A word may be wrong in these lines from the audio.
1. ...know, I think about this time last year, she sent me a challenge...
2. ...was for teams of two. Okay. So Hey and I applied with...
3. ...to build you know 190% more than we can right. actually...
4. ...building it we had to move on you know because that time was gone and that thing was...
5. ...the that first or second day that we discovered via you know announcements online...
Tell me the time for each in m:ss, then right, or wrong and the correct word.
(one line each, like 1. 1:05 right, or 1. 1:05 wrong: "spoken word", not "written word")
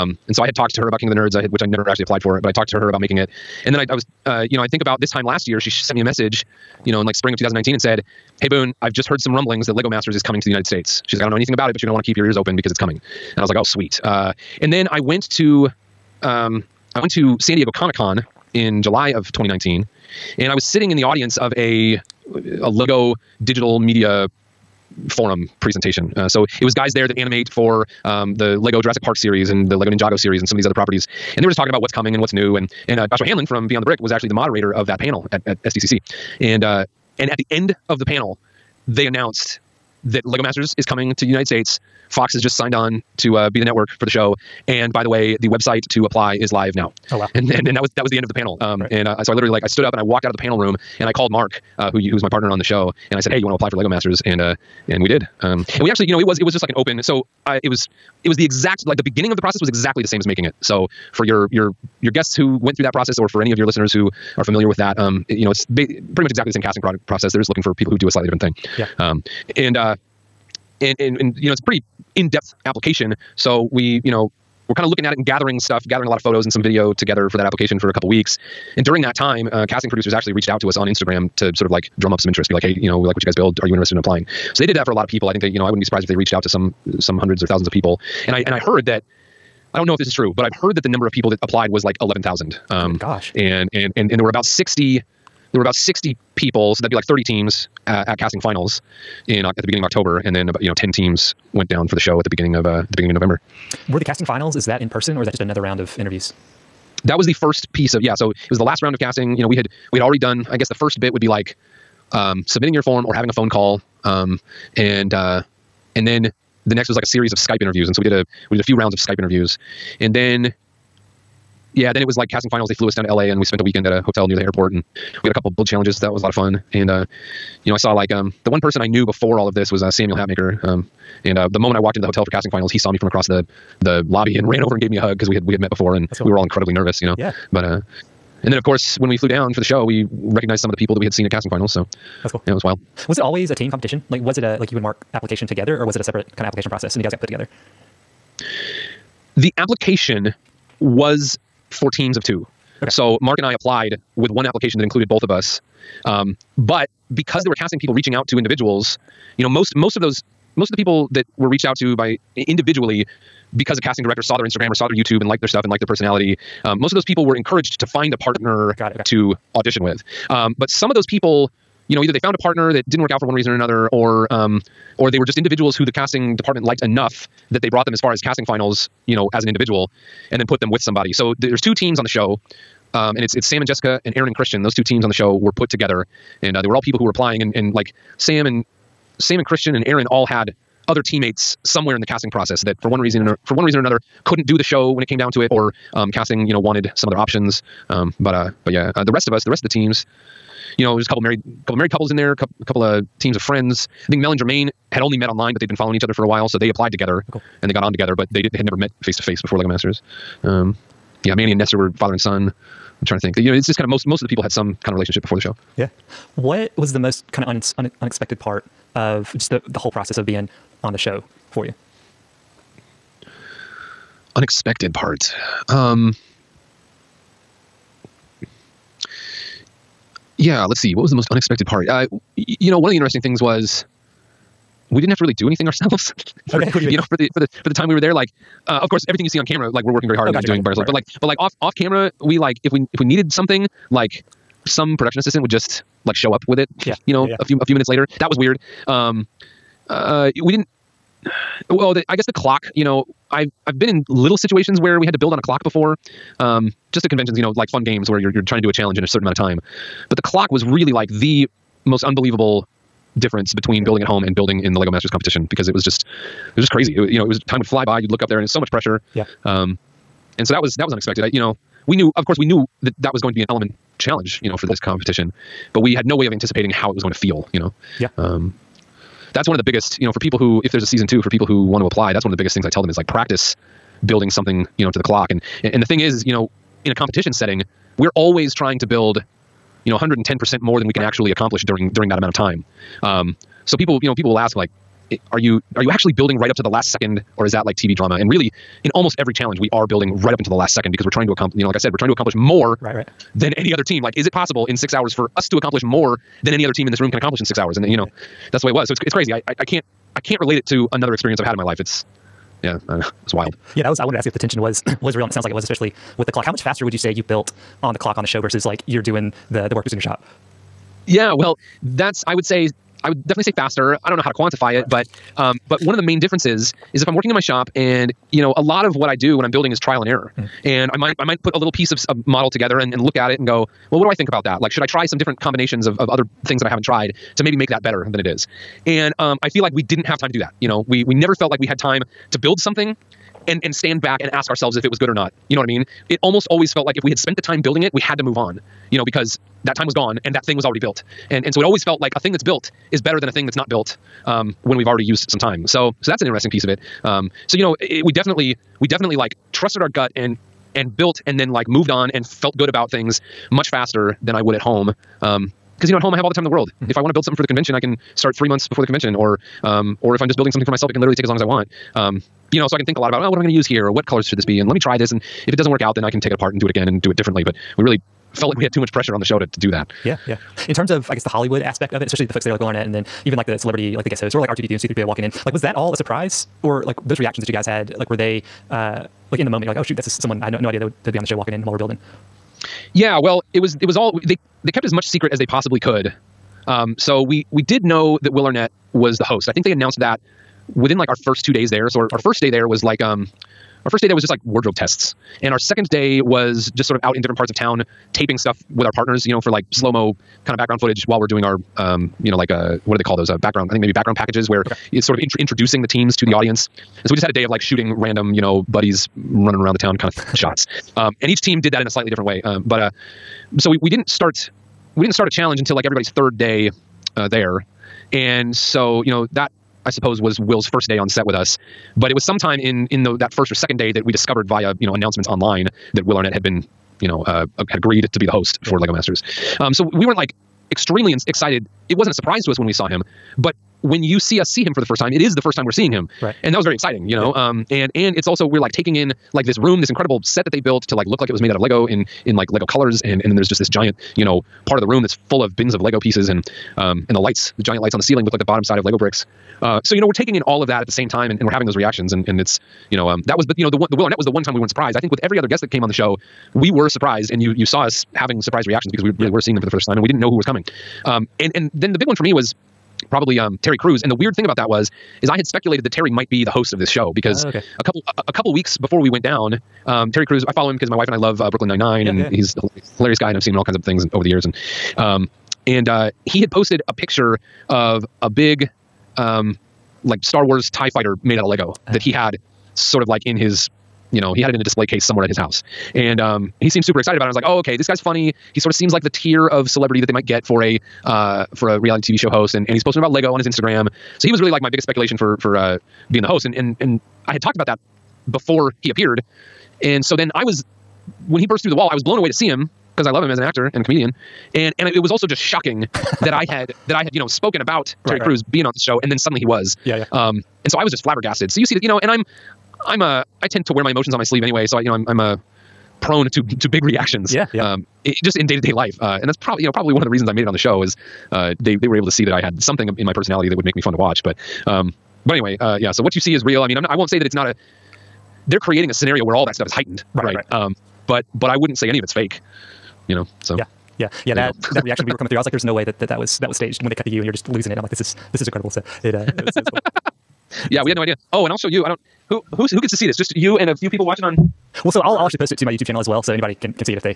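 1. 0:04 wrong: "message", not "challenge"
2. 2:30 wrong: "Mark", not "Hey"
3. 4:48 wrong: "110", not "190"
4. 5:47 right
5. 7:13 right.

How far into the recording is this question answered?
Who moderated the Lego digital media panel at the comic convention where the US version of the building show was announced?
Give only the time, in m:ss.
0:33.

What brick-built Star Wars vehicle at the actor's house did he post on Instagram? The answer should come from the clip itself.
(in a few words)
Tie Fighter.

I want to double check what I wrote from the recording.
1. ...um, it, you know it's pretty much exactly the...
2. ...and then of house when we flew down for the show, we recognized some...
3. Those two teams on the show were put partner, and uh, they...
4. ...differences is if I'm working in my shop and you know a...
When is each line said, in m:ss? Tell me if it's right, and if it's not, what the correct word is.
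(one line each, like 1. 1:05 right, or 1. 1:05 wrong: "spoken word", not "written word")
1. 1:04 right
2. 2:18 wrong: "course", not "house"
3. 3:04 wrong: "together", not "partner"
4. 5:26 right.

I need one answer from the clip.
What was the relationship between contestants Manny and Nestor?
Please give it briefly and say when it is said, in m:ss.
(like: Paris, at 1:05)
Father and son, at 3:31.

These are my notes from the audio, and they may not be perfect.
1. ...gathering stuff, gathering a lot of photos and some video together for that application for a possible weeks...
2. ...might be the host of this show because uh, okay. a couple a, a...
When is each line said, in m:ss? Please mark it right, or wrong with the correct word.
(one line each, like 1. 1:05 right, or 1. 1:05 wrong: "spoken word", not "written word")
1. 1:15 wrong: "couple", not "possible"
2. 7:56 right.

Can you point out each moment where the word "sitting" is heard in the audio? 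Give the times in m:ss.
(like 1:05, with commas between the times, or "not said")
0:20.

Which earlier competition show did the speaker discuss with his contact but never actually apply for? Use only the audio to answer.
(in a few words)
King of the Nerds.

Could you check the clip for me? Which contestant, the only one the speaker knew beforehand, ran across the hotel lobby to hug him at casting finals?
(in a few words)
Samuel Hatmaker.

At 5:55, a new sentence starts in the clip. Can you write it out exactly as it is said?
So so that's an interesting piece of it.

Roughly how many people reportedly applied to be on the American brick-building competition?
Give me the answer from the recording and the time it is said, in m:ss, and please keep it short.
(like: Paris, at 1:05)
11,000, at 1:32.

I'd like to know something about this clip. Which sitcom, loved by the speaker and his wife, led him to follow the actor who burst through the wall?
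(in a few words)
Brooklyn Nine Nine.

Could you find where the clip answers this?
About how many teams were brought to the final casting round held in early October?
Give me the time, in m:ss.
1:37.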